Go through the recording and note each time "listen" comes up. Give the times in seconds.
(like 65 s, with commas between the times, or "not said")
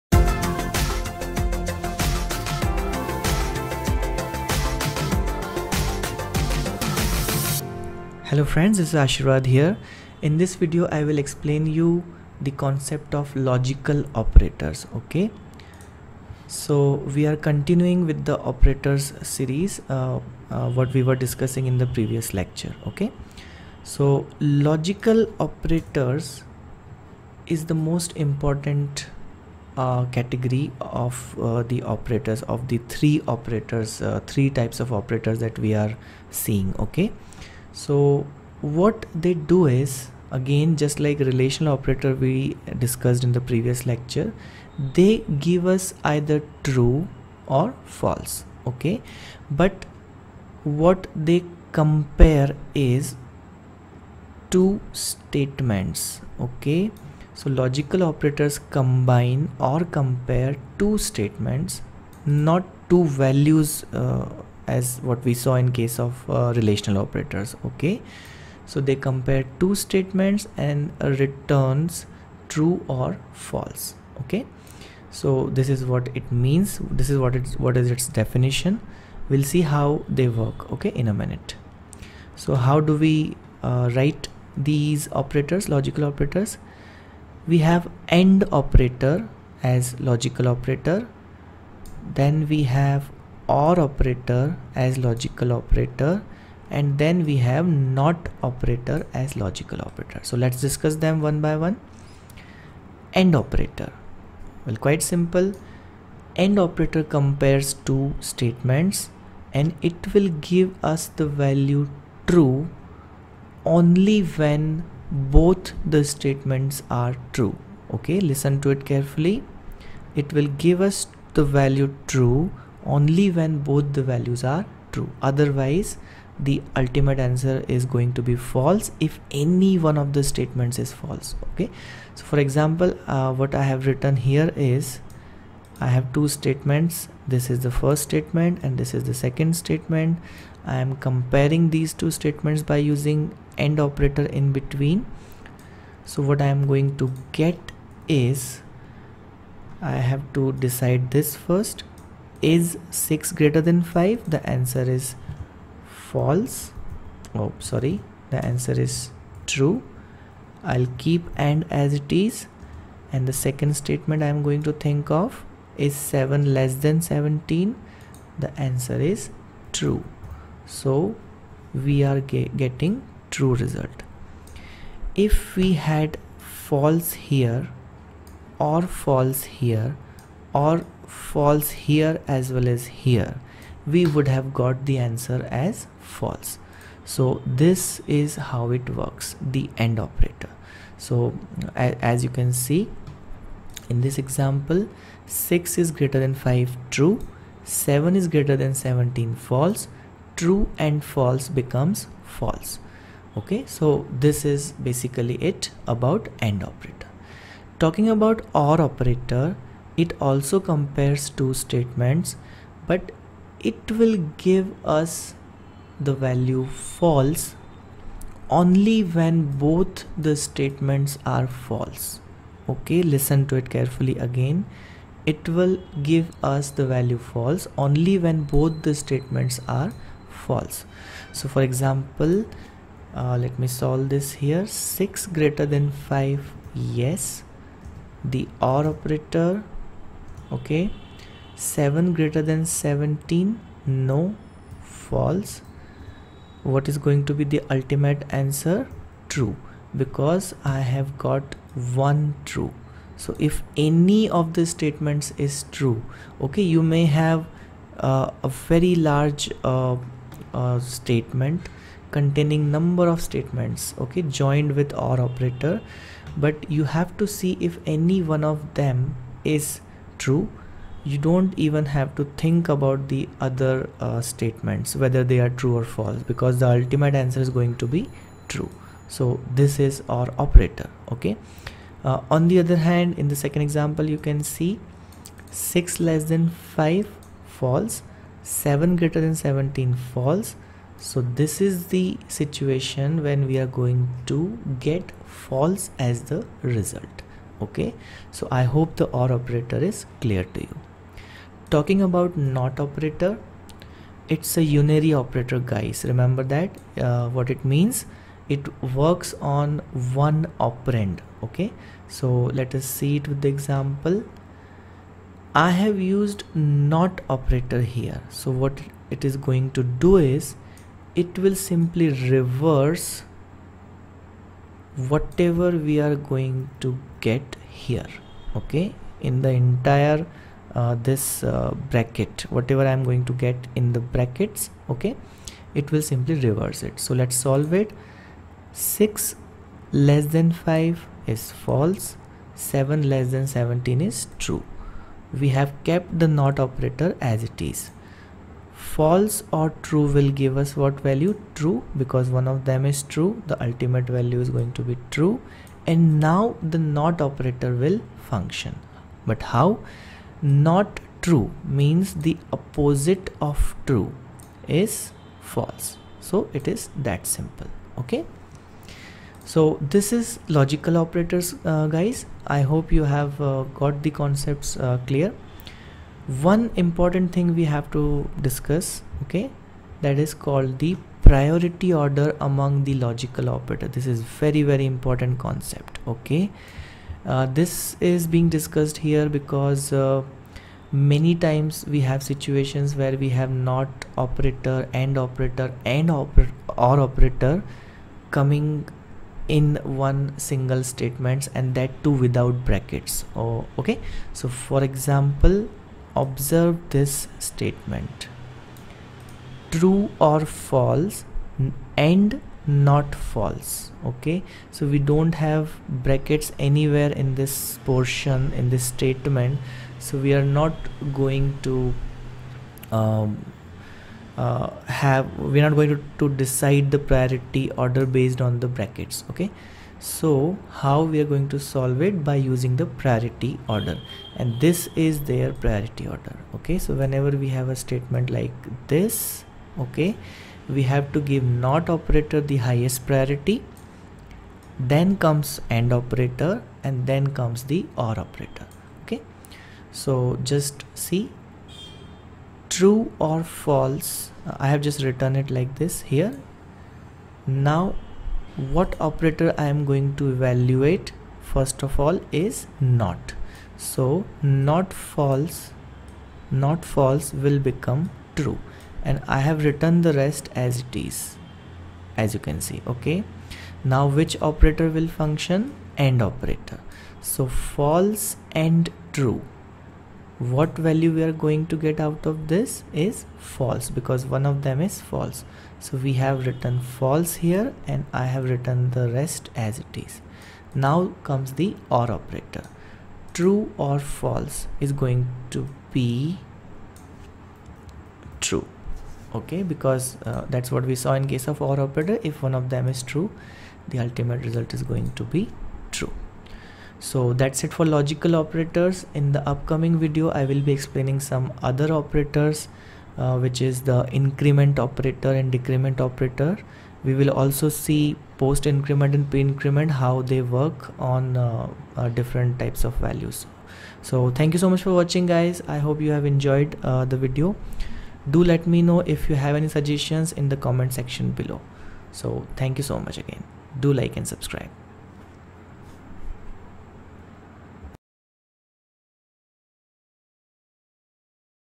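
118 s, 223 s.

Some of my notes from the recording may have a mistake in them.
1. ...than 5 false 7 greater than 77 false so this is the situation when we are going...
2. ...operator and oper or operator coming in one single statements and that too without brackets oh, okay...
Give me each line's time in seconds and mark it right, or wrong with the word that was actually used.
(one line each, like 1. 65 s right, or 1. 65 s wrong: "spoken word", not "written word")
1. 286 s wrong: "17", not "77"
2. 395 s right.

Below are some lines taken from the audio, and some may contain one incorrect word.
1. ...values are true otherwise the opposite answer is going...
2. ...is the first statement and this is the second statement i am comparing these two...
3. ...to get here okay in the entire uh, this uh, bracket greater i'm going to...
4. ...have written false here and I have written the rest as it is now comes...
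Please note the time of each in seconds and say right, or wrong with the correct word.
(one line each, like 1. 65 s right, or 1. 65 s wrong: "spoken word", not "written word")
1. 124 s wrong: "ultimate", not "opposite"
2. 137 s right
3. 326 s wrong: "whatever", not "greater"
4. 486 s right.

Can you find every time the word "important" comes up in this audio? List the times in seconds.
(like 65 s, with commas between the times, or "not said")
28 s, 376 s, 384 s.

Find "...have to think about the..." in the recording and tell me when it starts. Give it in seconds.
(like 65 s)
271 s.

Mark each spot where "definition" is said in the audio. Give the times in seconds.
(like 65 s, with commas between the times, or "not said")
78 s.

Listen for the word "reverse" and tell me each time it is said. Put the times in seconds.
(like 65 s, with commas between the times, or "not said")
322 s, 336 s.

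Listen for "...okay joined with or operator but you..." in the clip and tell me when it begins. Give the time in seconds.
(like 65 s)
263 s.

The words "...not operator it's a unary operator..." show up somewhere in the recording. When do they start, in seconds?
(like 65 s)
302 s.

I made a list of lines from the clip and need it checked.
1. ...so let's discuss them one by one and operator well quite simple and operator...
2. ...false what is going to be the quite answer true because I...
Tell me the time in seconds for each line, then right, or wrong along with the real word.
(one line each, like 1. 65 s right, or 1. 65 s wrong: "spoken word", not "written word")
1. 100 s right
2. 245 s wrong: "ultimate", not "quite".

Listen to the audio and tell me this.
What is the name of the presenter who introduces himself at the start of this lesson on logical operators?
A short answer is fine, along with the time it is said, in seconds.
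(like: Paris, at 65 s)
Ashirwad, at 8 s.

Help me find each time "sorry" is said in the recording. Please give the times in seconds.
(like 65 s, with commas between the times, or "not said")
157 s.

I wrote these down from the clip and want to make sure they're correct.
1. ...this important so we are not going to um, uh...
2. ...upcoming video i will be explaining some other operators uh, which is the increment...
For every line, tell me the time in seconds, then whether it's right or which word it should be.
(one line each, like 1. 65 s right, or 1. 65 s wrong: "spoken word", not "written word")
1. 418 s wrong: "statement", not "important"
2. 509 s right.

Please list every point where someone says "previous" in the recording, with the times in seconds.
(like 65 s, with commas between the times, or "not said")
21 s, 43 s.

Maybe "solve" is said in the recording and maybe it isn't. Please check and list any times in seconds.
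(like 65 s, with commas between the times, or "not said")
233 s, 337 s, 431 s.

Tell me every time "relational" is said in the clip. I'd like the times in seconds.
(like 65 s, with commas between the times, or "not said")
41 s, 66 s.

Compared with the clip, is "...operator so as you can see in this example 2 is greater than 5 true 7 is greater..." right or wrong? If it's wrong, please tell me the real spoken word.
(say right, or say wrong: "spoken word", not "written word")
wrong: "6", not "2".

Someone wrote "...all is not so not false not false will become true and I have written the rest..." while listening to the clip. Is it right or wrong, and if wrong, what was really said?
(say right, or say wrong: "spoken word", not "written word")
right.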